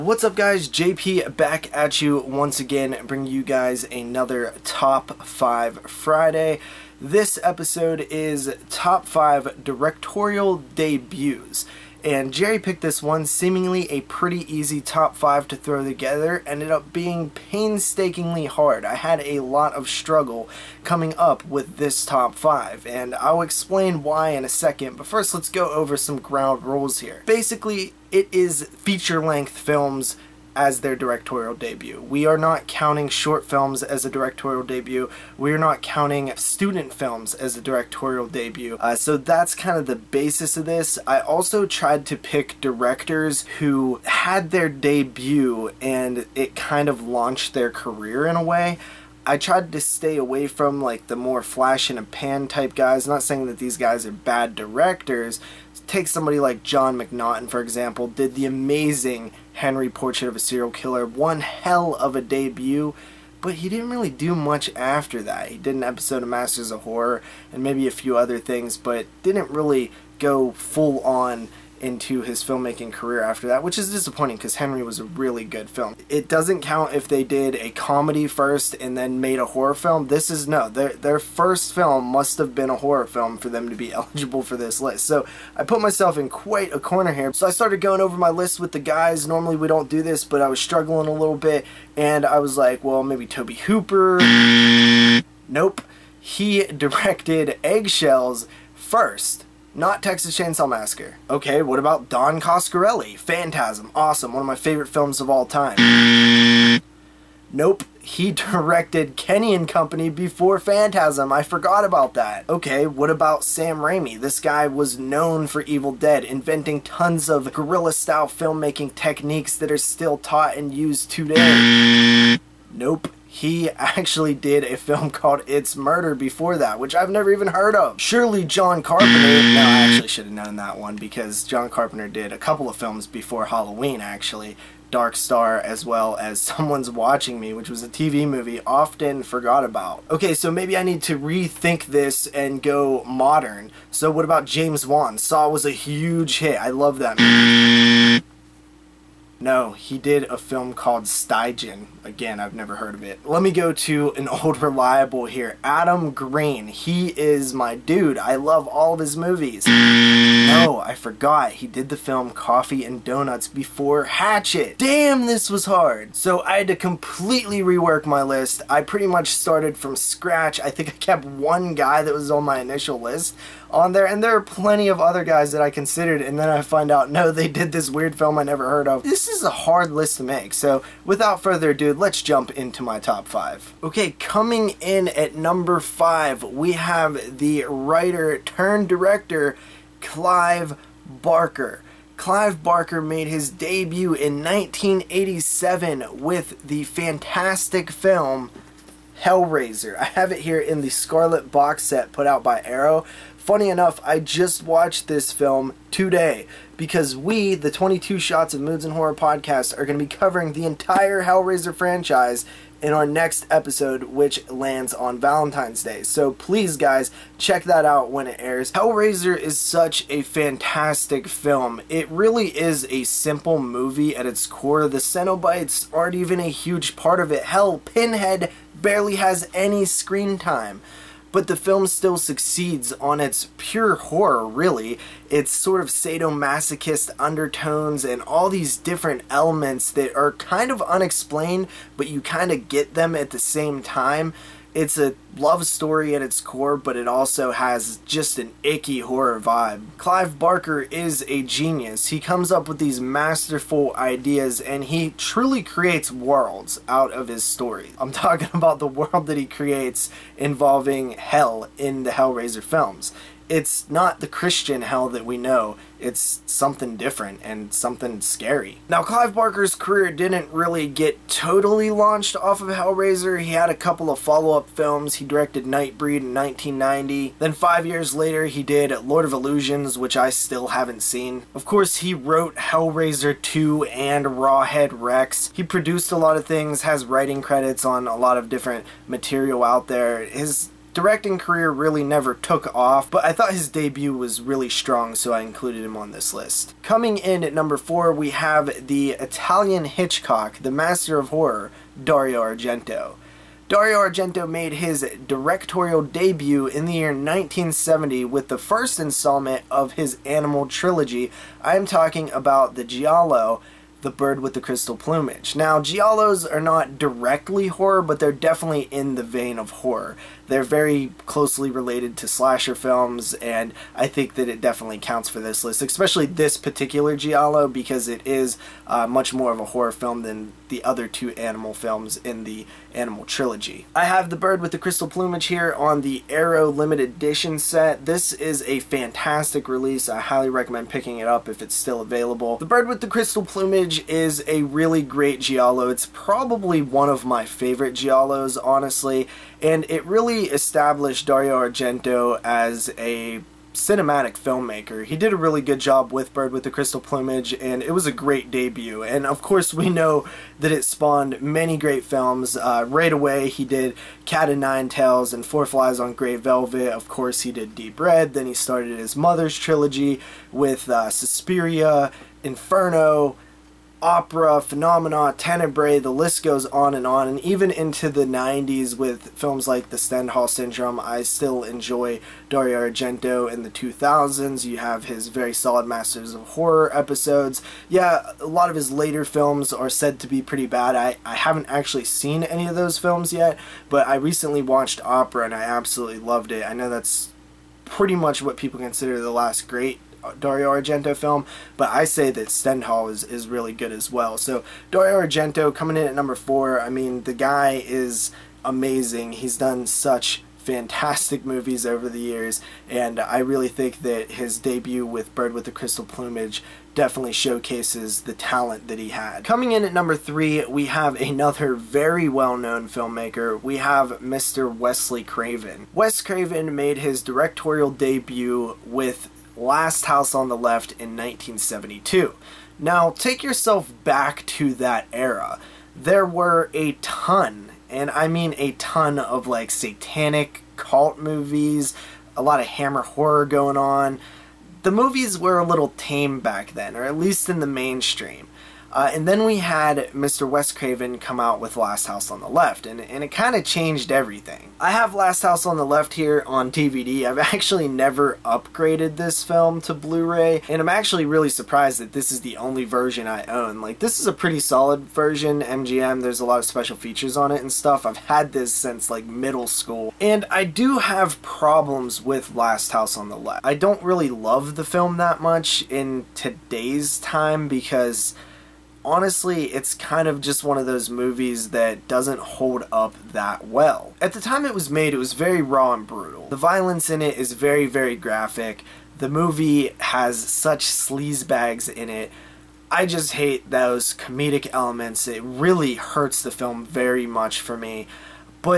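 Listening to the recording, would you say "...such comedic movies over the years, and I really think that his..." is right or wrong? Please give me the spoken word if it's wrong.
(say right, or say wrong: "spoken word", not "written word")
wrong: "fantastic", not "comedic".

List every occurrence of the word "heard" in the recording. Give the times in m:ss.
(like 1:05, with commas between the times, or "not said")
2:07, 2:32, 2:58.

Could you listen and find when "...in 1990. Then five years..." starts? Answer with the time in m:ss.
4:36.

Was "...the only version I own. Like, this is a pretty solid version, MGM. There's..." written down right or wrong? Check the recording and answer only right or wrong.
right.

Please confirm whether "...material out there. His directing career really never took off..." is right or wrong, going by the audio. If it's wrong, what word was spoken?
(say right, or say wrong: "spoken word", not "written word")
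right.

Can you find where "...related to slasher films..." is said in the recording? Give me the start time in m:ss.
5:21.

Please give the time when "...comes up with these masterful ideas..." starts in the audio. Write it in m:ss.
4:12.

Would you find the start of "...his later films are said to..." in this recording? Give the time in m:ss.
6:28.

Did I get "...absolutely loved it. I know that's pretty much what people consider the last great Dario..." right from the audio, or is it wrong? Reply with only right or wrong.
right.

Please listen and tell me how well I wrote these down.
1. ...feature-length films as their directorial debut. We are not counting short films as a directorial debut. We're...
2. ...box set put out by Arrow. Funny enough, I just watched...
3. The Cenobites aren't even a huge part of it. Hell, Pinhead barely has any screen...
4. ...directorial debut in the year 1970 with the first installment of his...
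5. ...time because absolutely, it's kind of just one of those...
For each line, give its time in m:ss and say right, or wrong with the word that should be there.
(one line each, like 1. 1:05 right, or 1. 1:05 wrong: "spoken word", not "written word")
1. 0:28 right
2. 3:21 right
3. 3:44 right
4. 5:05 right
5. 7:57 wrong: "honestly", not "absolutely".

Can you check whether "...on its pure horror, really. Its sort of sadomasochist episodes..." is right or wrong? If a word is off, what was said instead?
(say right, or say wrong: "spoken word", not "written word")
wrong: "undertones", not "episodes".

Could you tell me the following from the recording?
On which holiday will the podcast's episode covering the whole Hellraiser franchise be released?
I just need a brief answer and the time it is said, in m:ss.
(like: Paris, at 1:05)
Valentine's Day, at 3:35.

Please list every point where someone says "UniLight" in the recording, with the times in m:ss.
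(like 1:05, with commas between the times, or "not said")
not said.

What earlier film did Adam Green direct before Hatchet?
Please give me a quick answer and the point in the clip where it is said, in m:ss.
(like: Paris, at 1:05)
Coffee and Donuts, at 2:42.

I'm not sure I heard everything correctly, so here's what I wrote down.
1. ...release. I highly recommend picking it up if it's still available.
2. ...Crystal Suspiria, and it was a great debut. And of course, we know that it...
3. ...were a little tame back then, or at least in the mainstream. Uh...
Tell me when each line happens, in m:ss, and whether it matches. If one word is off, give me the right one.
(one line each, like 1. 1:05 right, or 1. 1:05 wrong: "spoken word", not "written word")
1. 5:39 right
2. 5:56 wrong: "Plumage", not "Suspiria"
3. 7:25 right.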